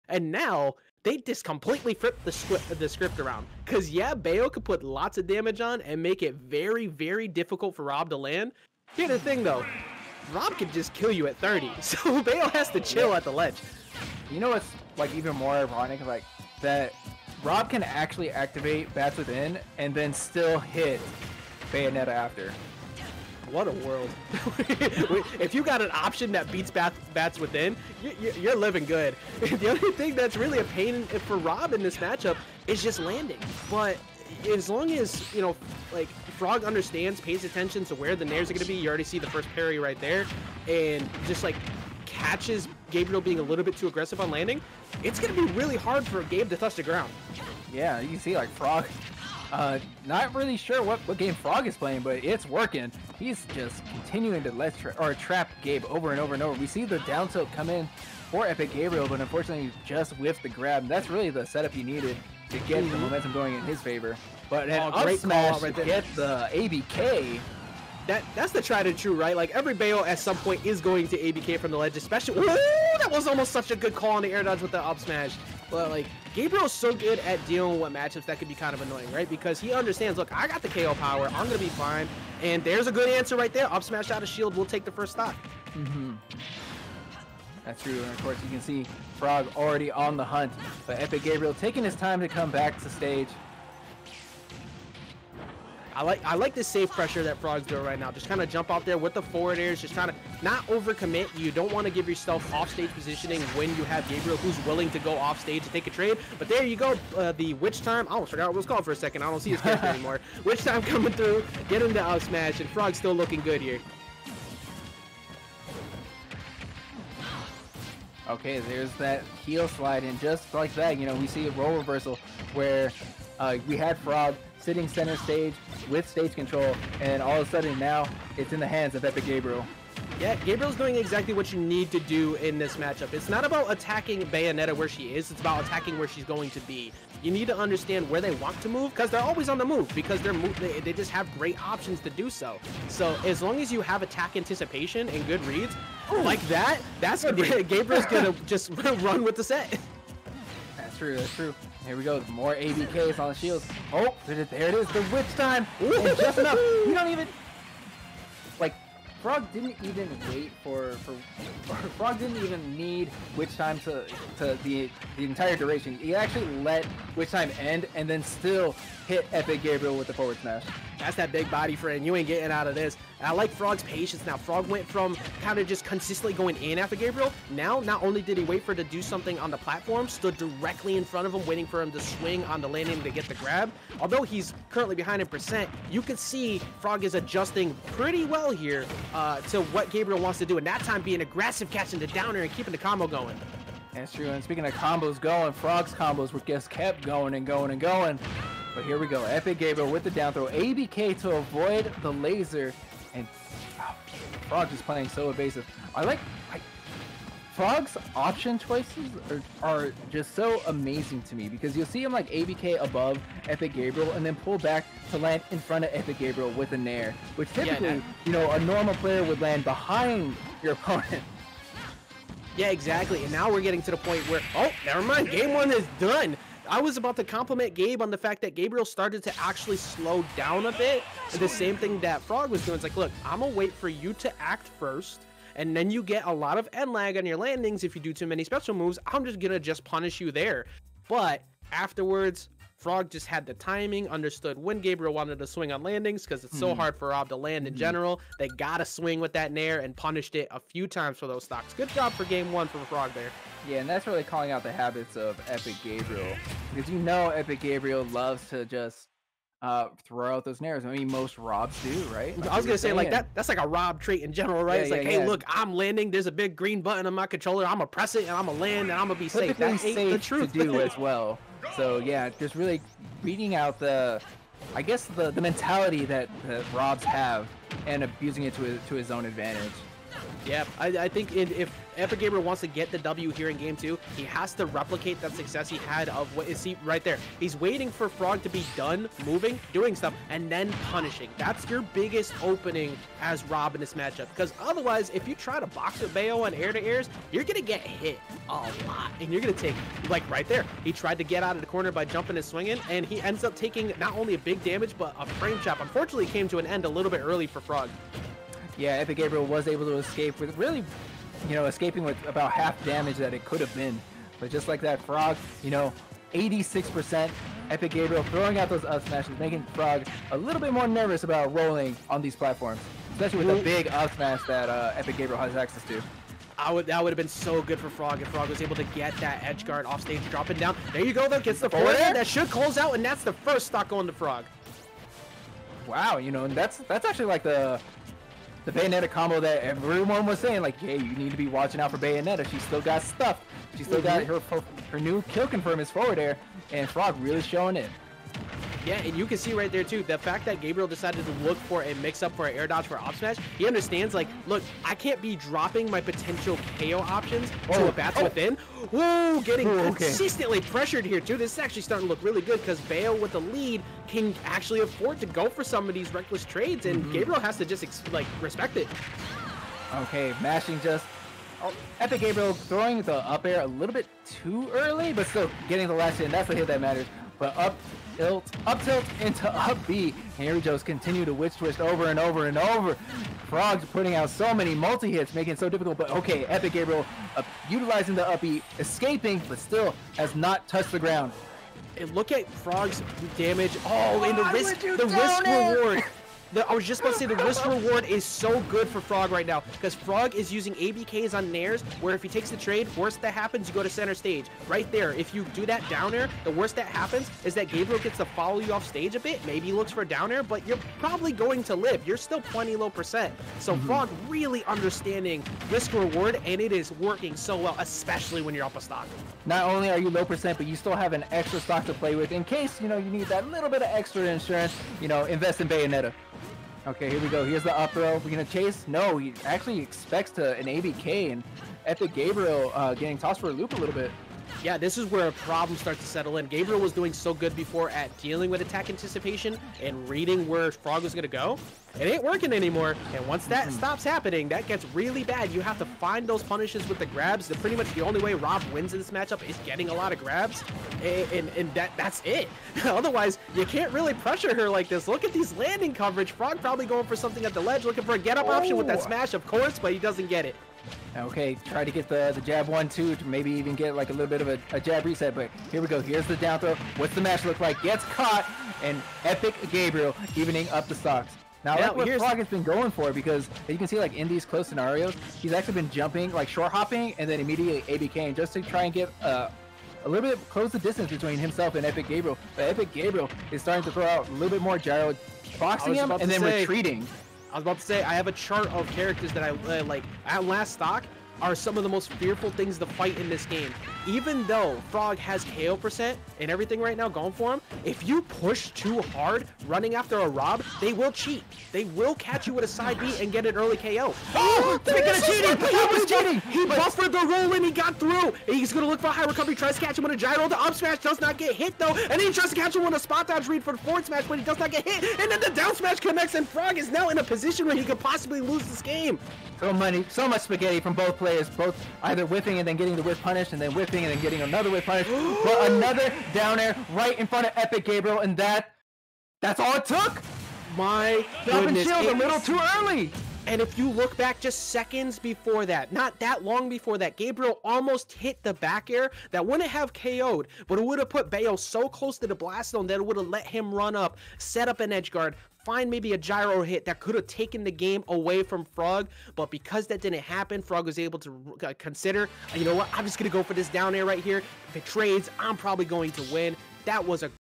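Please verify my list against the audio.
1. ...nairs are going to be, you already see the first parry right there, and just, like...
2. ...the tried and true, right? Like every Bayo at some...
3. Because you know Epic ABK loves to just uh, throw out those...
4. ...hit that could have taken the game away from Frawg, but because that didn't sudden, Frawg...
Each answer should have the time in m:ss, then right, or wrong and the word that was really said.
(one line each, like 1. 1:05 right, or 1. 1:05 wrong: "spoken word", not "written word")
1. 0:38 right
2. 1:08 right
3. 4:16 wrong: "Gabriel", not "ABK"
4. 9:06 wrong: "happen", not "sudden".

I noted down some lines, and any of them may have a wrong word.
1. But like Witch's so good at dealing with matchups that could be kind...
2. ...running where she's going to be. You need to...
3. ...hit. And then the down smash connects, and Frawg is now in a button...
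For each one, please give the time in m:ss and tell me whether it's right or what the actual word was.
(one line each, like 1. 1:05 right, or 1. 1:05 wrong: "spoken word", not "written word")
1. 1:15 wrong: "Gabriel", not "Witch"
2. 2:15 wrong: "attacking", not "running"
3. 8:34 wrong: "position", not "button".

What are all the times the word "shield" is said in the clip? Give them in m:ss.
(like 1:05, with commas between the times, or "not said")
1:24, 2:33, 8:51.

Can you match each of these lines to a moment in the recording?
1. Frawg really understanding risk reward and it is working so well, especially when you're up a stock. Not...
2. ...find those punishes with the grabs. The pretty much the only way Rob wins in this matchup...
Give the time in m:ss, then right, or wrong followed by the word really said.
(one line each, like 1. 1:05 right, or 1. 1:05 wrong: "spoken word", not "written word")
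1. 6:53 right
2. 7:26 right.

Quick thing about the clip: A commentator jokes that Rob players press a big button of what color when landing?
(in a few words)
green.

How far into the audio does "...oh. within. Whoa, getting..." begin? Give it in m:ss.
5:58.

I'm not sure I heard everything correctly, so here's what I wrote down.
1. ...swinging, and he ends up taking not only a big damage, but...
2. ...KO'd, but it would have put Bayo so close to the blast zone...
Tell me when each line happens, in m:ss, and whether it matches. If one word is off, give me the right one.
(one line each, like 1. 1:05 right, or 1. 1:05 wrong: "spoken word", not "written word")
1. 5:02 right
2. 8:59 right.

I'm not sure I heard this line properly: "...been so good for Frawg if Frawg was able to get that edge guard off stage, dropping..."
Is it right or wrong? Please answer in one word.
right.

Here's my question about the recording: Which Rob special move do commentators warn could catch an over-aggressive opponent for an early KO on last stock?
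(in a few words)
side B.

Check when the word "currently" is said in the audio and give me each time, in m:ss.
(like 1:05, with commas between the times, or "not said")
3:04.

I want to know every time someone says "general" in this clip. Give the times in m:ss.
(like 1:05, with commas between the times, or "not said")
4:07, 4:24.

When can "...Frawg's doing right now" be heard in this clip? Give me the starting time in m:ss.
1:37.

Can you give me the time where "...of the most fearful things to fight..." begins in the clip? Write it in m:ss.
8:11.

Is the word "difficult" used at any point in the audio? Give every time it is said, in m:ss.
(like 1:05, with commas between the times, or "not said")
0:07, 6:25.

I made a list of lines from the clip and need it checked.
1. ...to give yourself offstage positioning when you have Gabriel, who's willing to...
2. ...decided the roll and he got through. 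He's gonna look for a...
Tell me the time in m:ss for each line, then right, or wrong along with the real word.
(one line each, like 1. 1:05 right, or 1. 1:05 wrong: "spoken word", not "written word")
1. 1:41 right
2. 8:26 wrong: "buffered", not "decided".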